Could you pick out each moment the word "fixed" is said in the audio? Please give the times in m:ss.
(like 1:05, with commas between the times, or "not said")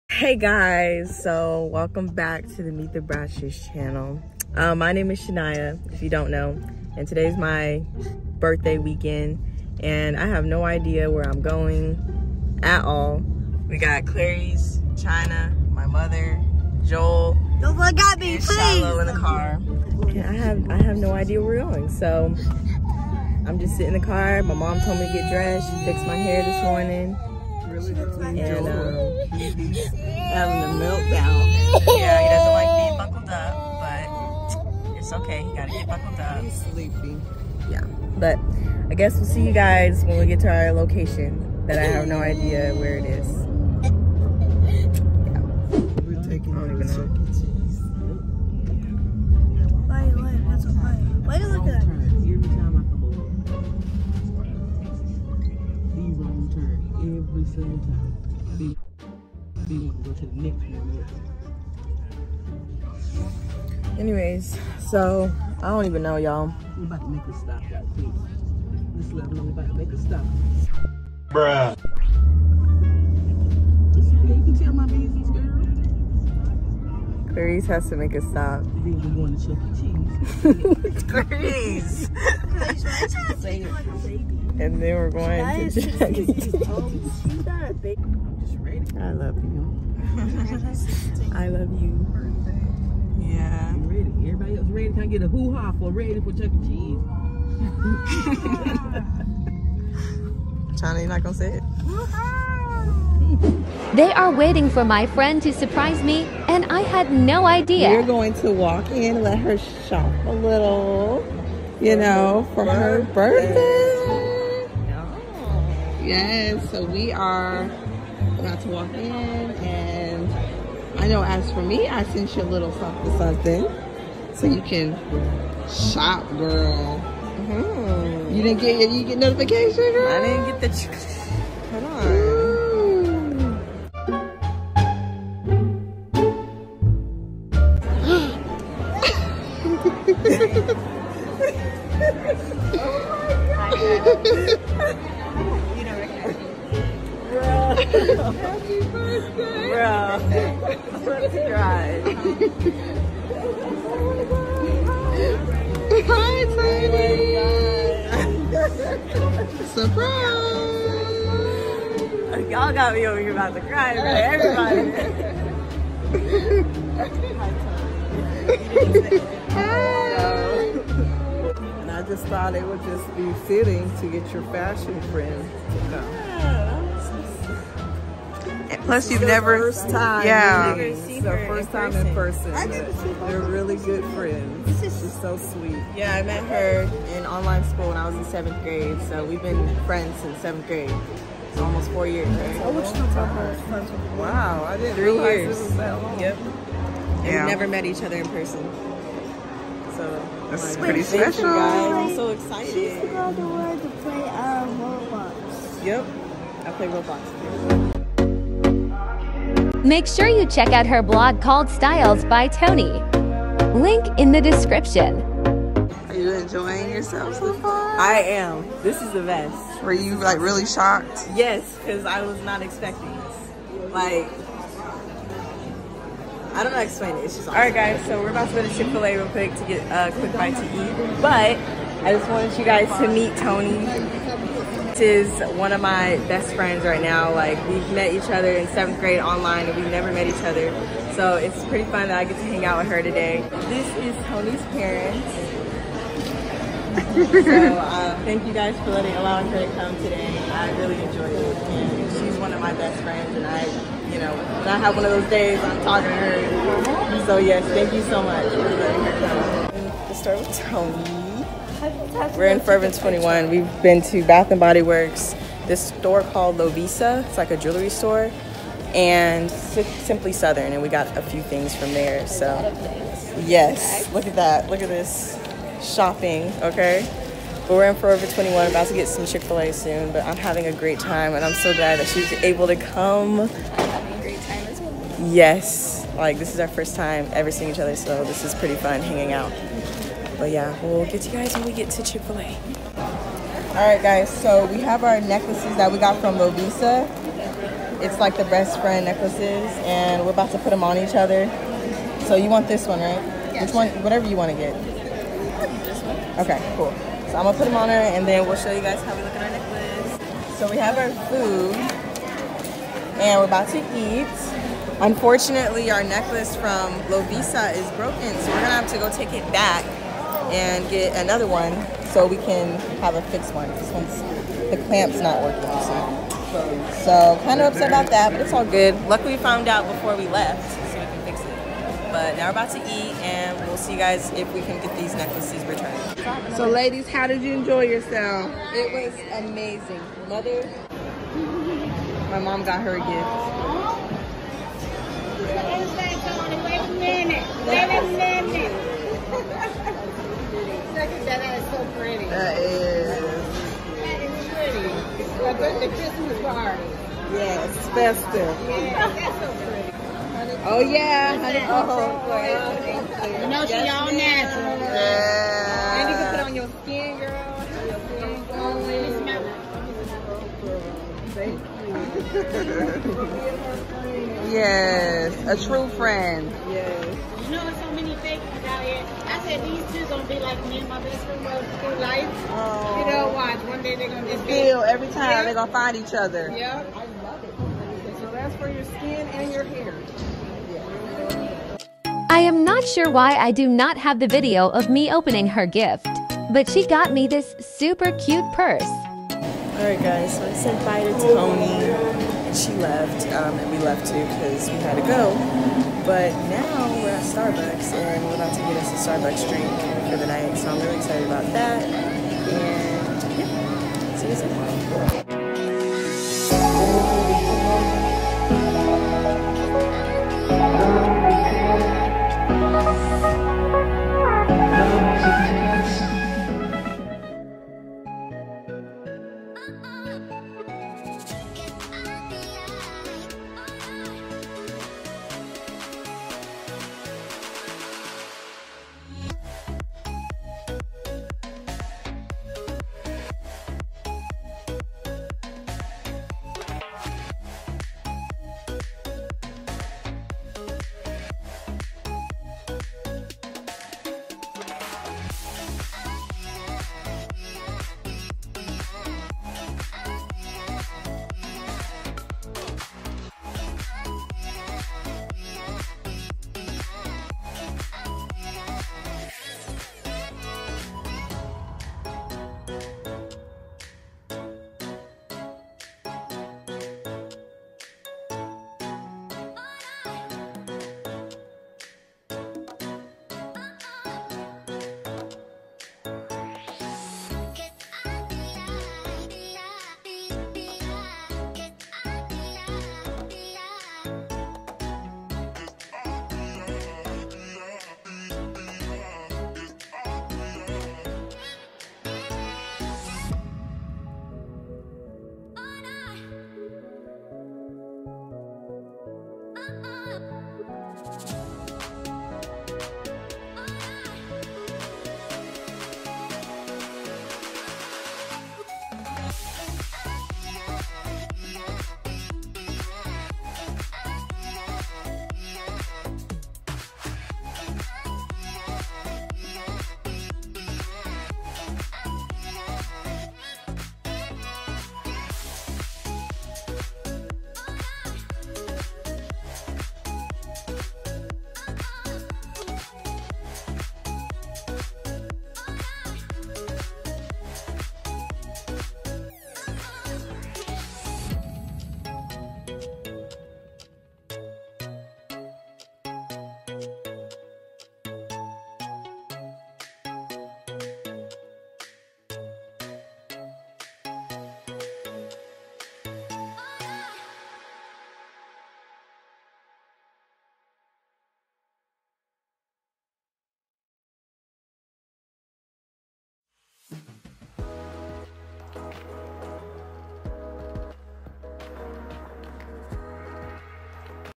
0:25, 5:23.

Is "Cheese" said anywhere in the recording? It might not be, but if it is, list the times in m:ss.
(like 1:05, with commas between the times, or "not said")
1:20, 1:36.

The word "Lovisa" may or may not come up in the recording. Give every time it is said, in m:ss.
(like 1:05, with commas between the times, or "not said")
4:26, 4:56, 5:17.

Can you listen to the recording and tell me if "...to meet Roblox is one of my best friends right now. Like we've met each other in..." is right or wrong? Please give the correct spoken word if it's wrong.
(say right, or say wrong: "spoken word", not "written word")
wrong: "Toni", not "Roblox".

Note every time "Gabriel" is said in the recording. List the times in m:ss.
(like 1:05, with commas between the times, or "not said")
not said.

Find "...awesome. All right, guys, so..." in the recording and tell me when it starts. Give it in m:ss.
3:47.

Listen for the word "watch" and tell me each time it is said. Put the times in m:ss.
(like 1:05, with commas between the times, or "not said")
6:23.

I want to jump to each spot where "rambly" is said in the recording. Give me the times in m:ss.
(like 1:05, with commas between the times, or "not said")
not said.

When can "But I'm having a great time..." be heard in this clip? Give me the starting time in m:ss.
4:40.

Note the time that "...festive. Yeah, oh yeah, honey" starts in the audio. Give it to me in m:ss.
5:57.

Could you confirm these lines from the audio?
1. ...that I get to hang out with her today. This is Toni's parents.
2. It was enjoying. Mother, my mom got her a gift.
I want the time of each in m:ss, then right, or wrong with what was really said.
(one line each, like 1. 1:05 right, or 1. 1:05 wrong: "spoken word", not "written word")
1. 4:02 right
2. 5:38 wrong: "amazing", not "enjoying".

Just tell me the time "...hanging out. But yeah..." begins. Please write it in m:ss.
4:49.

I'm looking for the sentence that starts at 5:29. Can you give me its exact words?
Luckily we found out before we left so we can fix it.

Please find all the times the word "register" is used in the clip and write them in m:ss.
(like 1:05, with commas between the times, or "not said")
not said.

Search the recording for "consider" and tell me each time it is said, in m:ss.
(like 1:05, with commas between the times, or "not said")
not said.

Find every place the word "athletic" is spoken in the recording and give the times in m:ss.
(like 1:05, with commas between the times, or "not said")
not said.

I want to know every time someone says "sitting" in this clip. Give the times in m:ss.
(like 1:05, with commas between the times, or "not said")
0:23.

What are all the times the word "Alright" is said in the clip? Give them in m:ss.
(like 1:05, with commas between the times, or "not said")
6:39.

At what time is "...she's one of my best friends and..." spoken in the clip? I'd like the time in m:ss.
4:12.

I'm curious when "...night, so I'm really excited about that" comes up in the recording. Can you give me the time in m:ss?
6:50.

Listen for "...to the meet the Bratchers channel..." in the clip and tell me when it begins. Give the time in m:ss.
0:02.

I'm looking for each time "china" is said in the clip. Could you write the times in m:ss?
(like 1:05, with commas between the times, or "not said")
0:14, 1:40.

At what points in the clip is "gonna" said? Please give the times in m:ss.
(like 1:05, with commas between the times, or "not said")
1:41, 5:07, 5:18, 6:20, 6:25.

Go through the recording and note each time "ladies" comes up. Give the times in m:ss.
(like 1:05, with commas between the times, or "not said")
5:36.